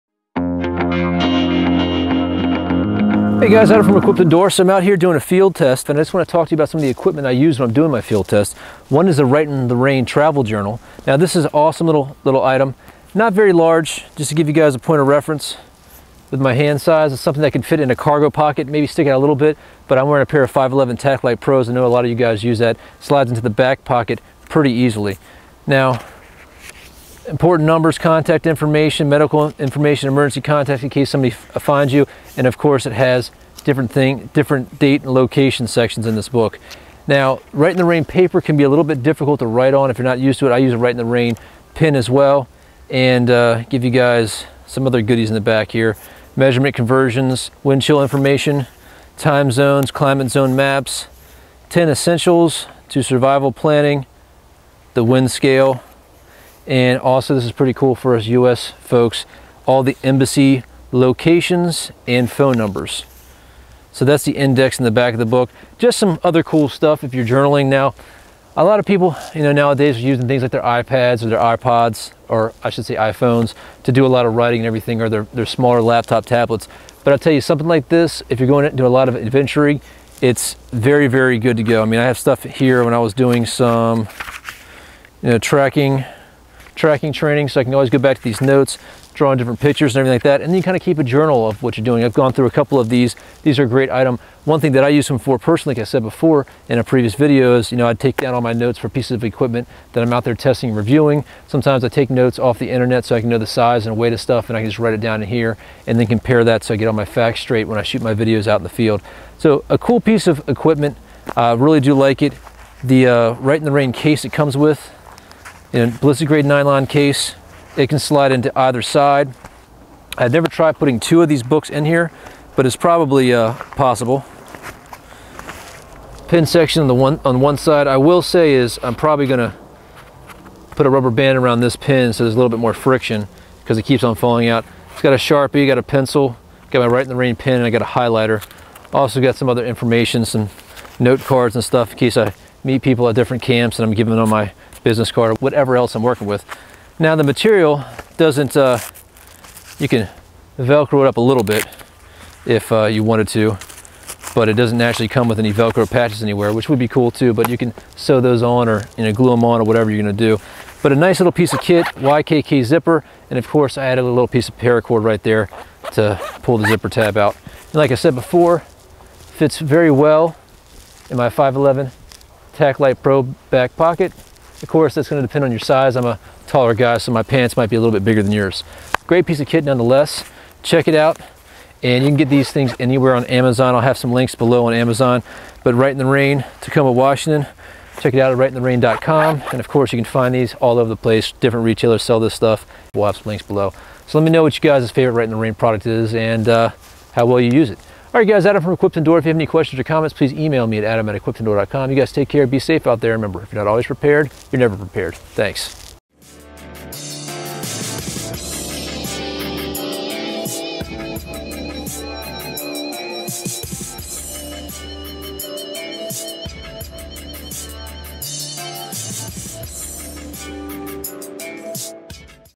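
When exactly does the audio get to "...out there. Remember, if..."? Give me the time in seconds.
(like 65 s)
202 s.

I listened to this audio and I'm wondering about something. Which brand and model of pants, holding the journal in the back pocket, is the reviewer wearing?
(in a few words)
511 TacLite Pros.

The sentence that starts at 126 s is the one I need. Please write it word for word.
Pin section on the one on one side.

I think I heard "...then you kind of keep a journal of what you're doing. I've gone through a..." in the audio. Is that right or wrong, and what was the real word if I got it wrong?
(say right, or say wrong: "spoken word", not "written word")
right.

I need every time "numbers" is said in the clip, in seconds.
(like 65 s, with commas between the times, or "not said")
27 s, 62 s.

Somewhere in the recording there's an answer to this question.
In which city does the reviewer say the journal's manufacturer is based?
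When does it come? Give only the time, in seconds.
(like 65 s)
186 s.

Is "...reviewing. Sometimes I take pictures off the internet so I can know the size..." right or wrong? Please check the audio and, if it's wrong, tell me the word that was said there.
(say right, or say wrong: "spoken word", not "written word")
wrong: "notes", not "pictures".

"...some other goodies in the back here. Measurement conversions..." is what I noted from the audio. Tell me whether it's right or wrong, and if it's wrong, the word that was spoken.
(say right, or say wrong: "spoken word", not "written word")
right.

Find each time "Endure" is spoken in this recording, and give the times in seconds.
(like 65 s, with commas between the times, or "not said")
4 s, 198 s.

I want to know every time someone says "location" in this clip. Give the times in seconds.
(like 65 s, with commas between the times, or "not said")
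35 s, 60 s.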